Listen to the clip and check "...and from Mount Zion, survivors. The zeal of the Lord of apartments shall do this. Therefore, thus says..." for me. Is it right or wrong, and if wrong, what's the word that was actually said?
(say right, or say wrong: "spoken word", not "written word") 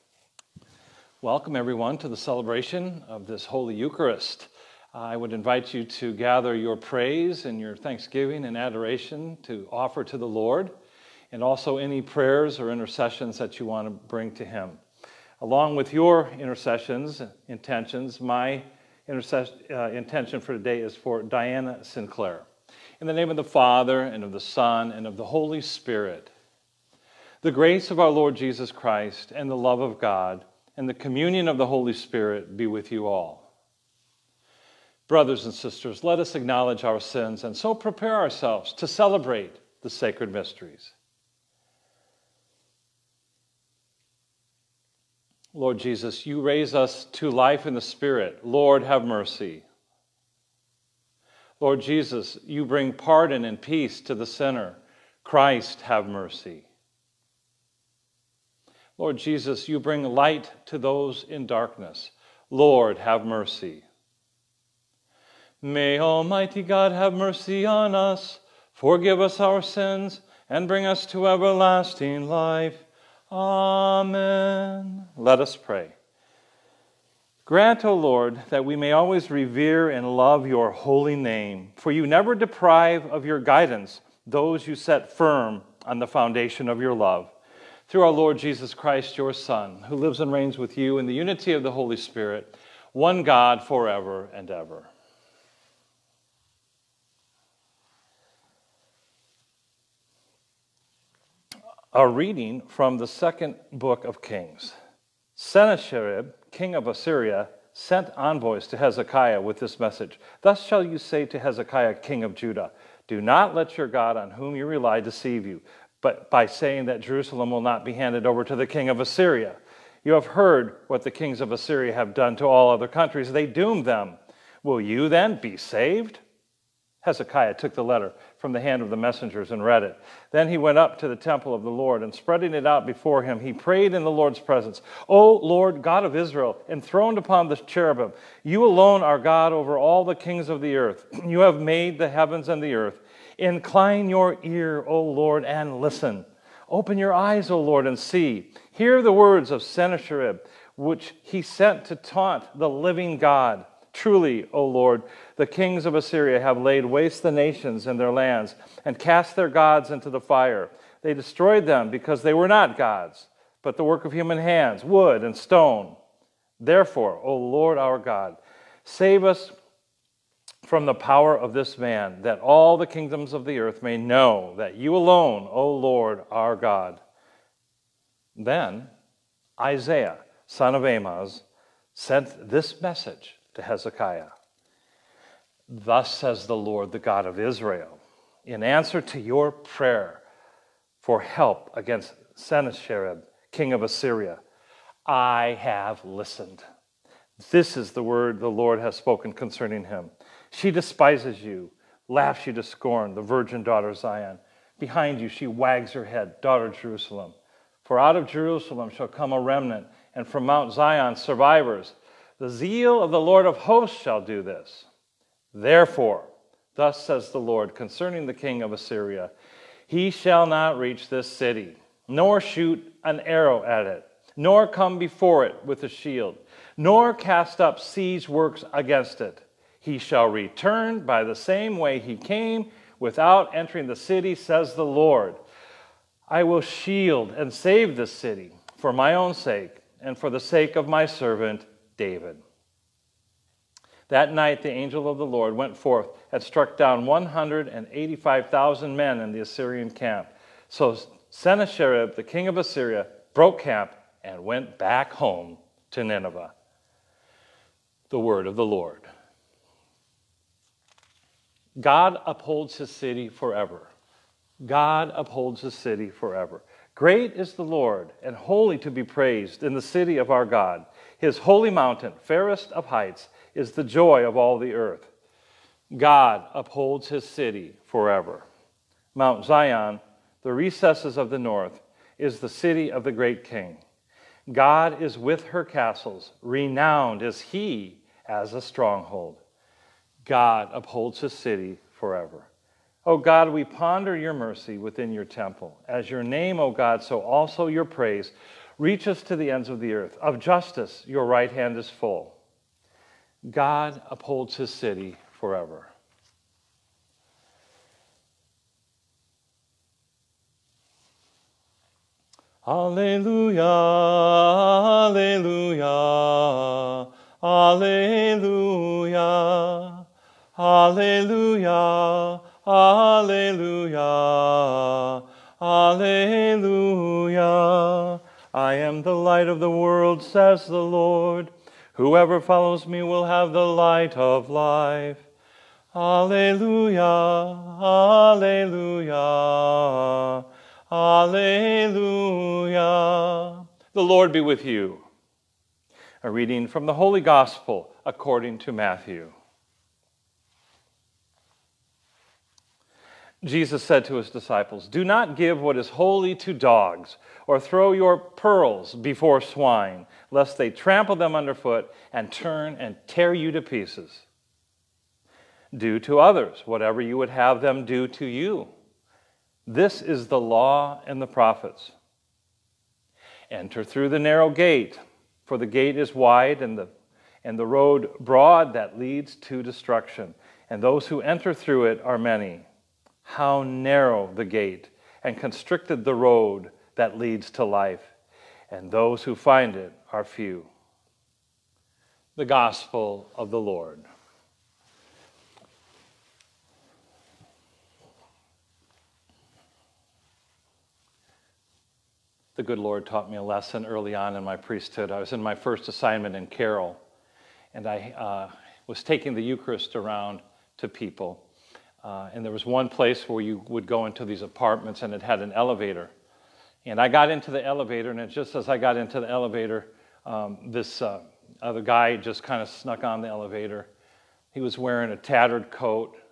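wrong: "hosts", not "apartments".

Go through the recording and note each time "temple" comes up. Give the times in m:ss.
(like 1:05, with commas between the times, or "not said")
2:11, 4:55.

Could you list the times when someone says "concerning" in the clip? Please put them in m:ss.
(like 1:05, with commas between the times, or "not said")
3:19, 3:37.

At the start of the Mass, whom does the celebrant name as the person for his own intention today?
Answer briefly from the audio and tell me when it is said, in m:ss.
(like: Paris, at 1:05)
Diana Sinclair, at 0:21.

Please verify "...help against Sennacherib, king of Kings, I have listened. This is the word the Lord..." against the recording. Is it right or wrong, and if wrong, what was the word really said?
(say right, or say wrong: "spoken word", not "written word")
wrong: "Assyria", not "Kings".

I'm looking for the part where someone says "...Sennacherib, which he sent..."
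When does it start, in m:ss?
2:29.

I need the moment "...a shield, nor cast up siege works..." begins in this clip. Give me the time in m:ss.
3:45.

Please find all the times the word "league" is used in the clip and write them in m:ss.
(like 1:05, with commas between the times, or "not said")
not said.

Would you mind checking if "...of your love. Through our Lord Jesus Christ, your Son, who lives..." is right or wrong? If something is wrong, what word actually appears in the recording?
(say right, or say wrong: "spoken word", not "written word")
right.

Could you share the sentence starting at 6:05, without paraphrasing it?
Do to others whatever you would have them do to you.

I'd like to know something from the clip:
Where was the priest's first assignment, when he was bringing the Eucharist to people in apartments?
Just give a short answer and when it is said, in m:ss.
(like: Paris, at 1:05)
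Carroll, at 6:46.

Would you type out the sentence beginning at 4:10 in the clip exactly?
So Sennacherib, the king of Assyria, broke camp and went back home to Nineveh.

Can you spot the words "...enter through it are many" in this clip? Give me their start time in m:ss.
6:21.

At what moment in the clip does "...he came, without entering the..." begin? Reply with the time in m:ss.
3:51.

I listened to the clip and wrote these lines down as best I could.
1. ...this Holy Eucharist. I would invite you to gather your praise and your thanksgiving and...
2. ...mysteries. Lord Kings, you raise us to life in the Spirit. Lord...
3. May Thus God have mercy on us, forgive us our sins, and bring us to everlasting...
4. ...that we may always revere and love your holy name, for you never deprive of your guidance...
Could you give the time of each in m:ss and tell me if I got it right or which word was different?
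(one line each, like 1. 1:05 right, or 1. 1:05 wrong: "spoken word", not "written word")
1. 0:03 right
2. 0:40 wrong: "Jesus", not "Kings"
3. 1:05 wrong: "Almighty", not "Thus"
4. 1:18 right.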